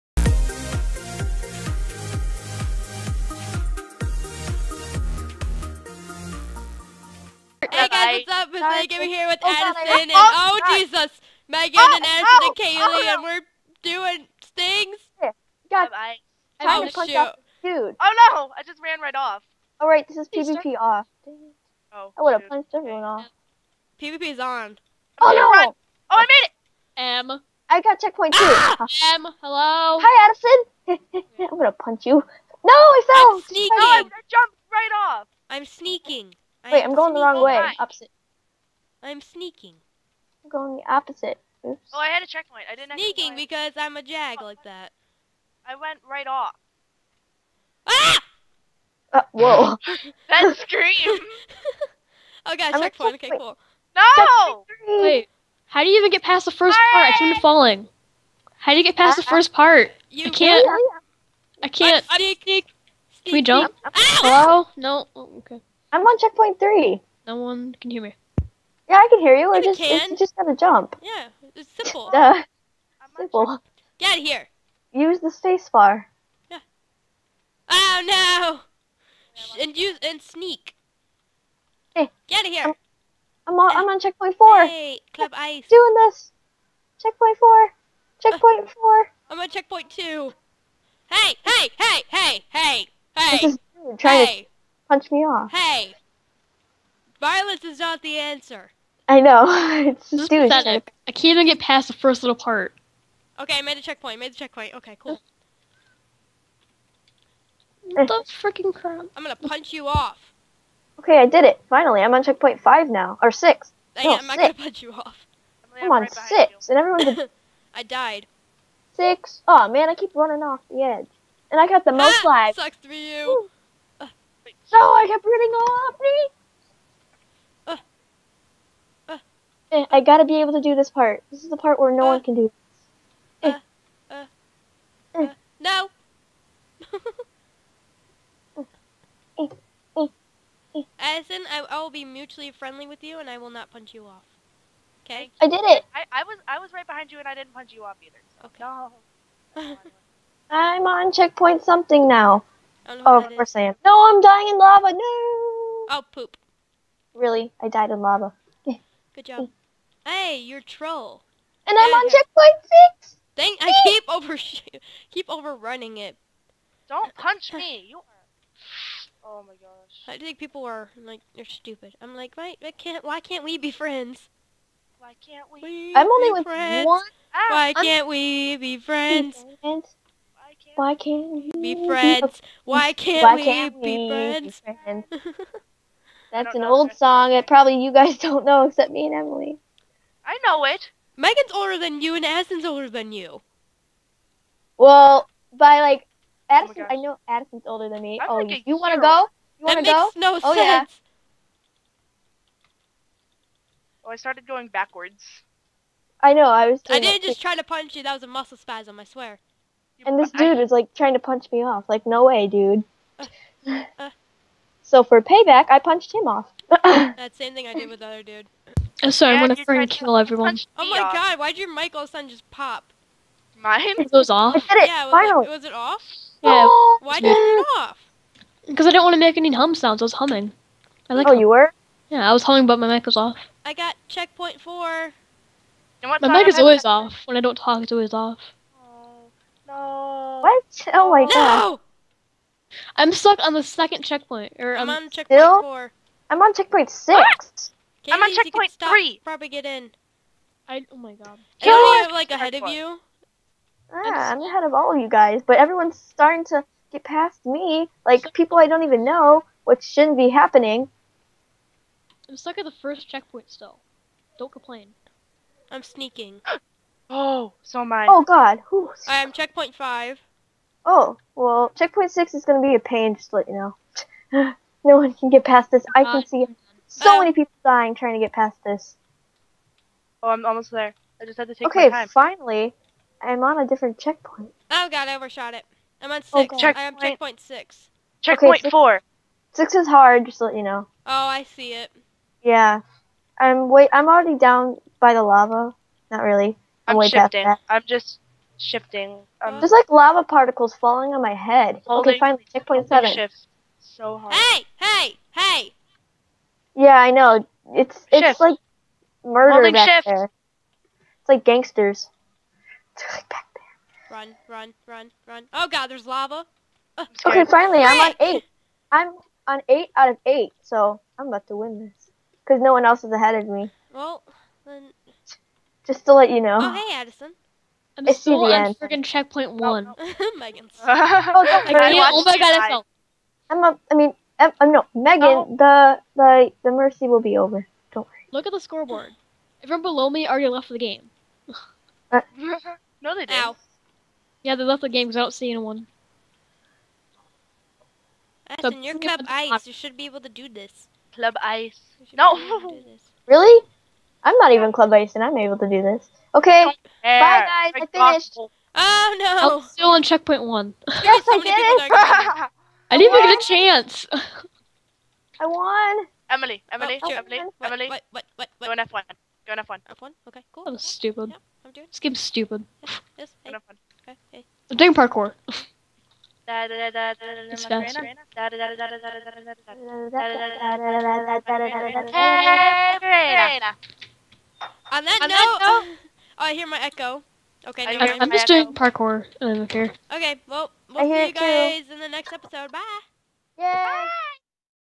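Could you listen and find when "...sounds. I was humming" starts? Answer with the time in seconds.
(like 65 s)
229 s.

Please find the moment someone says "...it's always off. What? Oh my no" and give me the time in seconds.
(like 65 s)
237 s.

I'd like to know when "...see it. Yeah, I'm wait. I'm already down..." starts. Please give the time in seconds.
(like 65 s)
291 s.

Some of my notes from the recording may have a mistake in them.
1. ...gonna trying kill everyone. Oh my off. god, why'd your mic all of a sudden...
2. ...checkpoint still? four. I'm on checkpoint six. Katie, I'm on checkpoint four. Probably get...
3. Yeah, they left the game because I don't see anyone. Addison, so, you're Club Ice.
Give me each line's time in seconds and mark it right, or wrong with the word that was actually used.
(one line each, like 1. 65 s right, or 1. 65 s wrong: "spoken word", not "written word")
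1. 219 s wrong: "freaking", not "trying"
2. 245 s wrong: "three", not "four"
3. 344 s right.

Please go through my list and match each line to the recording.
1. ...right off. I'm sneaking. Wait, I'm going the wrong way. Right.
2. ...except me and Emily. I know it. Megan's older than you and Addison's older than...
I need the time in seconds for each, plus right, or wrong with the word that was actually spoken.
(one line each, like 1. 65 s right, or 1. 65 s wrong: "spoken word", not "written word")
1. 34 s right
2. 188 s right.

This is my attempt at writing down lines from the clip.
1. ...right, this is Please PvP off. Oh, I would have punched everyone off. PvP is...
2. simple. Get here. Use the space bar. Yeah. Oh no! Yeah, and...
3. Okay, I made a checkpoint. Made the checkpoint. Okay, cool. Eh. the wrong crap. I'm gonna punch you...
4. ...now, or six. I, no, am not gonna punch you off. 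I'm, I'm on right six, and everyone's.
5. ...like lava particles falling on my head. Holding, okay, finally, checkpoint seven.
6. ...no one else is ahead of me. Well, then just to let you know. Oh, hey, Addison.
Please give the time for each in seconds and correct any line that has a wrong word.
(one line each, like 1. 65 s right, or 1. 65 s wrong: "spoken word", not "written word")
1. 19 s right
2. 73 s right
3. 103 s wrong: "freaking", not "wrong"
4. 112 s right
5. 299 s right
6. 322 s right.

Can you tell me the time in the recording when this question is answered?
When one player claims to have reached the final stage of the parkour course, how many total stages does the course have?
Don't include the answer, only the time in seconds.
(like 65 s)
318 s.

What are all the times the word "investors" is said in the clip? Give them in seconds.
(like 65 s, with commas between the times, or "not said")
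not said.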